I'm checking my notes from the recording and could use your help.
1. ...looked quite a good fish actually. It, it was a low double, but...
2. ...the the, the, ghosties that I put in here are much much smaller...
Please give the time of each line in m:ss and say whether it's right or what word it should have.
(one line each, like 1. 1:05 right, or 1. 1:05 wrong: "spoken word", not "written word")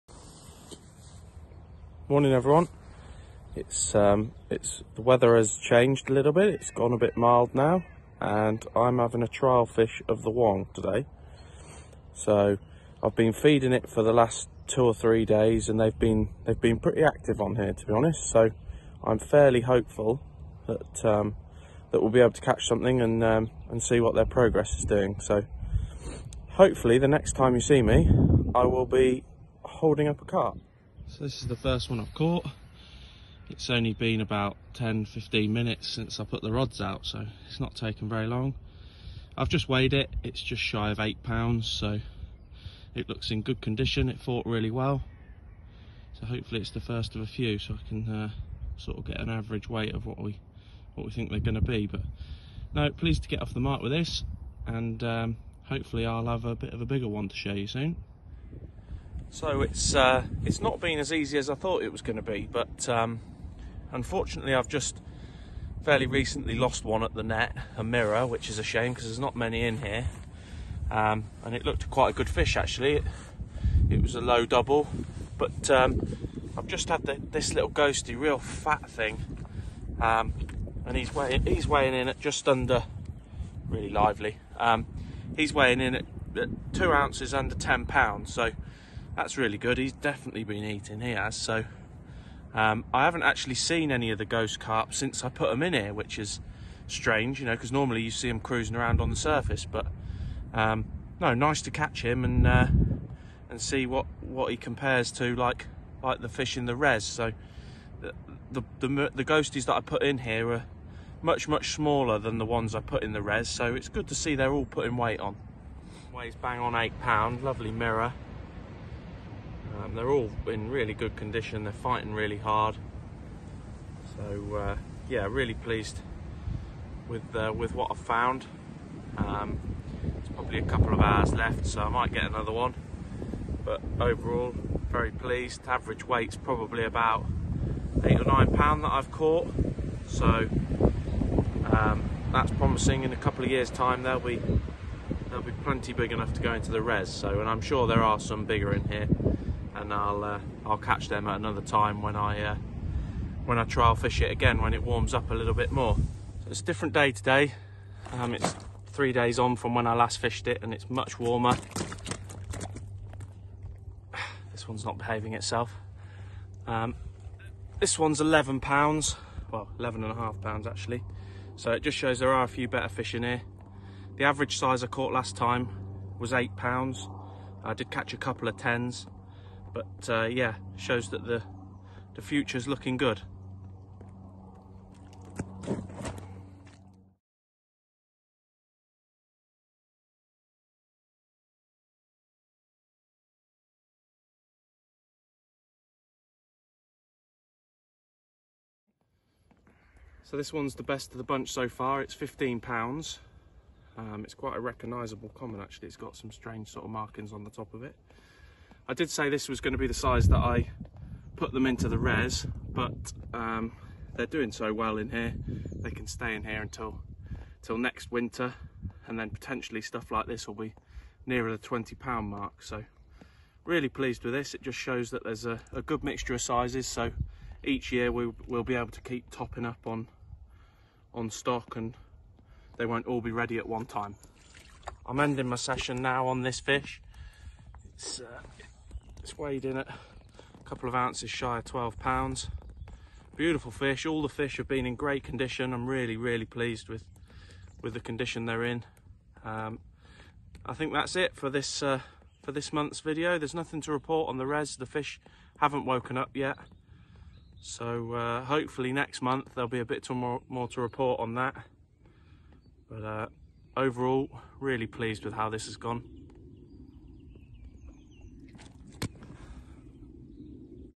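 1. 1:11 right
2. 1:48 right.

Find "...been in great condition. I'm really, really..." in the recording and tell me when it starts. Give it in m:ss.
4:04.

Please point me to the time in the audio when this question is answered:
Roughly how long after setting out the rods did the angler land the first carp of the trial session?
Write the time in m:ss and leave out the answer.
0:34.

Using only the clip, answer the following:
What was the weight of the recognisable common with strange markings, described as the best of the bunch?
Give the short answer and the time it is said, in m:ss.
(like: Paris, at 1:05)
15 pounds, at 3:22.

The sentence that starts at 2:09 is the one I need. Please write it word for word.
Um, it's probably a couple of hours left, so I might get another one.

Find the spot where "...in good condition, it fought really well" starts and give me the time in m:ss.
0:43.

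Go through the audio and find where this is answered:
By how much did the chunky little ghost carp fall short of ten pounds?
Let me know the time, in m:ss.
1:26.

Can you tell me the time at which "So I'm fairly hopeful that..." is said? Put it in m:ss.
0:18.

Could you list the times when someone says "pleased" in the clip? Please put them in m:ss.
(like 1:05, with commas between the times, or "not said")
0:52, 2:05, 2:15, 3:43, 4:06, 4:24.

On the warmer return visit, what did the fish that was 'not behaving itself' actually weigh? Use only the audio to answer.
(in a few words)
11.5 pounds.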